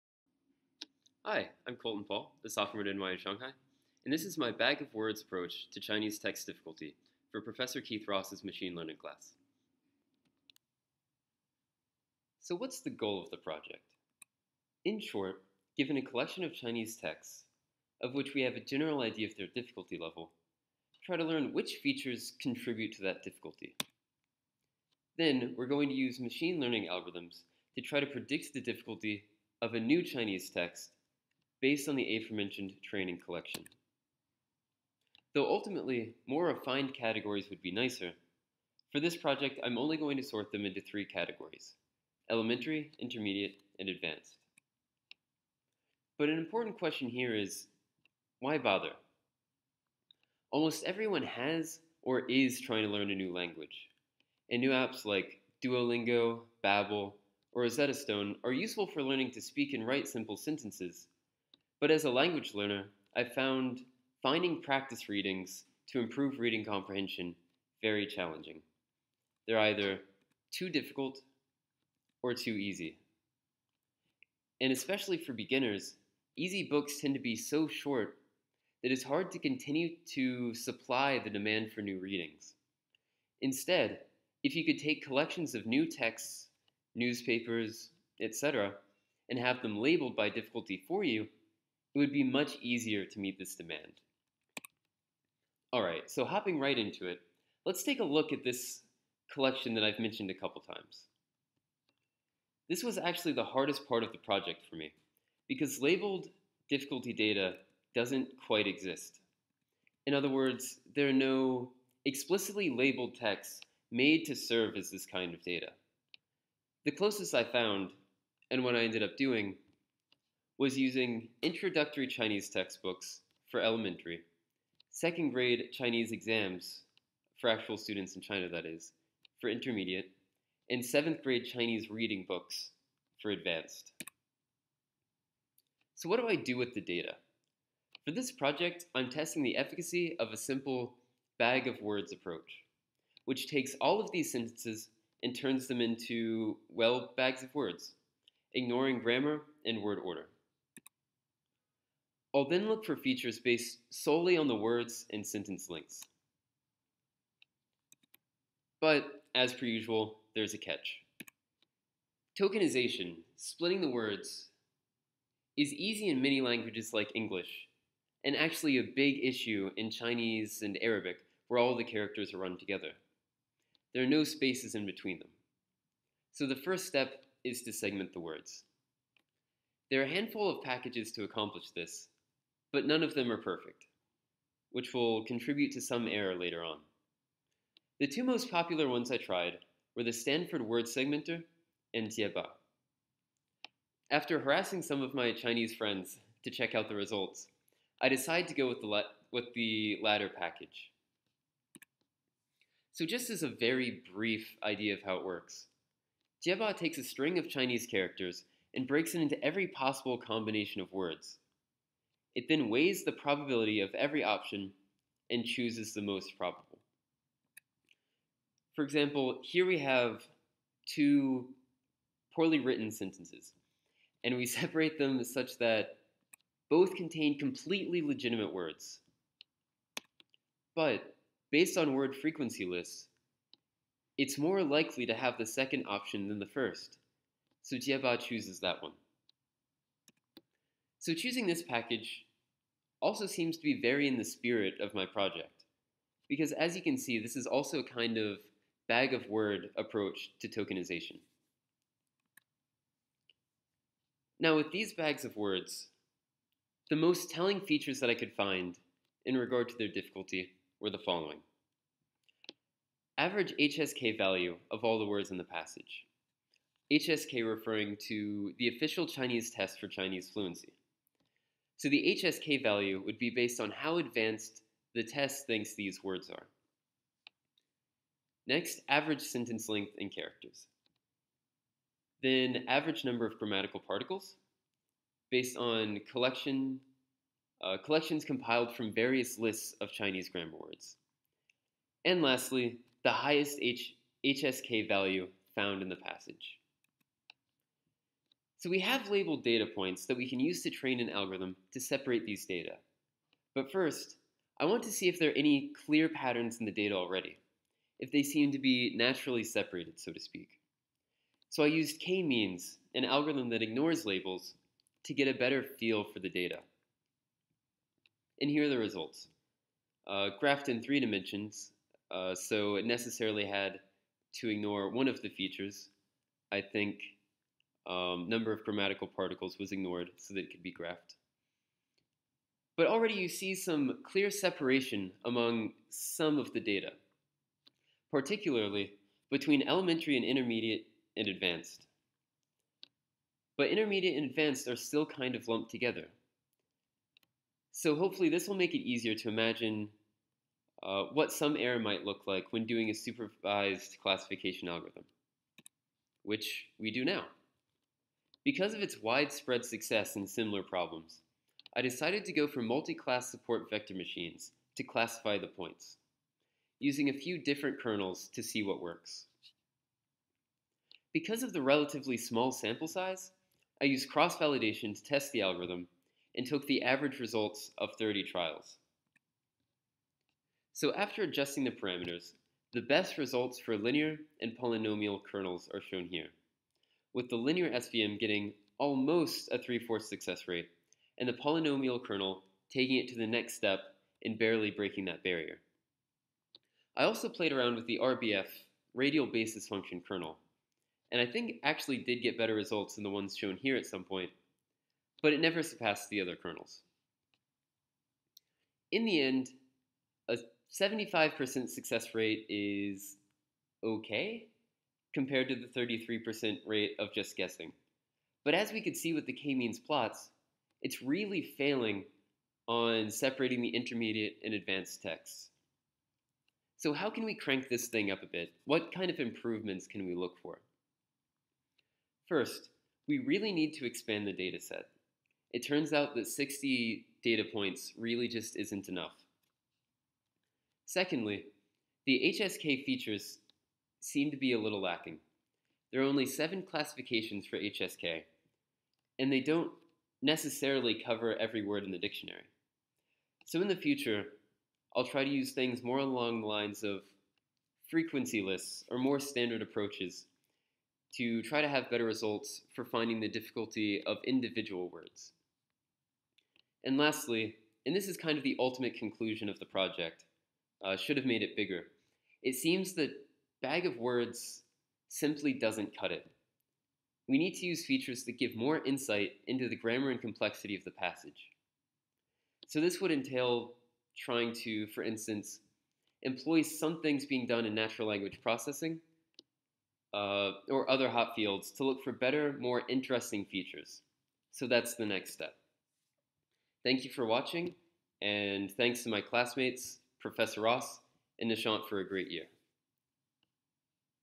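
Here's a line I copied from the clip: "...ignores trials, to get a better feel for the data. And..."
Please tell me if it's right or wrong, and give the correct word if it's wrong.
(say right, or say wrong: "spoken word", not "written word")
wrong: "labels", not "trials".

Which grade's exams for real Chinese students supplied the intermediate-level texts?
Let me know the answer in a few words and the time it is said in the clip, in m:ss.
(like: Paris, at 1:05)
Second grade, at 2:04.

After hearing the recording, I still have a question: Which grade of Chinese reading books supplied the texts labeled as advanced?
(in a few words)
Seventh grade.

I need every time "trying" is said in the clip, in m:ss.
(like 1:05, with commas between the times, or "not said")
0:52, 8:04.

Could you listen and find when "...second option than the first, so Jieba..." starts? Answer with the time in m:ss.
3:55.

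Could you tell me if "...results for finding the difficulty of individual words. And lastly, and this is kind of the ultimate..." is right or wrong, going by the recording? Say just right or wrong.
right.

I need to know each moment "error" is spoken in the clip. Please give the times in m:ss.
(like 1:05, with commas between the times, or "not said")
3:06, 5:51.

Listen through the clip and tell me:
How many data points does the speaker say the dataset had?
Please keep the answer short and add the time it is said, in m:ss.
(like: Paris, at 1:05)
60, at 7:16.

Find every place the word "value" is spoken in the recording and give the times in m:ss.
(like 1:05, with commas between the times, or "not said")
4:24, 4:32, 4:54.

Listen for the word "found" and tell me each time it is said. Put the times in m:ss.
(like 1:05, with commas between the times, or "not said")
1:03, 1:57, 4:55.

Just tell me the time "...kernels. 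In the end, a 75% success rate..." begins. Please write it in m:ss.
6:46.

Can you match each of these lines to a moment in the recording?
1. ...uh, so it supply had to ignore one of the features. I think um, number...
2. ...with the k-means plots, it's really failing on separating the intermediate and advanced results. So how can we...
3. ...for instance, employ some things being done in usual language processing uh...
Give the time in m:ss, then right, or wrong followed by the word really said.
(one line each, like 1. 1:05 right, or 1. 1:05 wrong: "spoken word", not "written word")
1. 5:22 wrong: "necessarily", not "supply"
2. 6:59 wrong: "texts", not "results"
3. 8:04 wrong: "natural", not "usual".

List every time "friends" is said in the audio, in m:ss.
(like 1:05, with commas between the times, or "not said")
3:15.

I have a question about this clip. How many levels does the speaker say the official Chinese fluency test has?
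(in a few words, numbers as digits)
7.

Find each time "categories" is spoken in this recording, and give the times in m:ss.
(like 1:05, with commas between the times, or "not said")
0:36, 0:41.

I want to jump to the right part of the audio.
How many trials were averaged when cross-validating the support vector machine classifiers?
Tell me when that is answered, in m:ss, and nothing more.
6:17.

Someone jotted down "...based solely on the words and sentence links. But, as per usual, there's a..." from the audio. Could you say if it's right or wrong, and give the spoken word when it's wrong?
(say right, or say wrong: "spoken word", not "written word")
right.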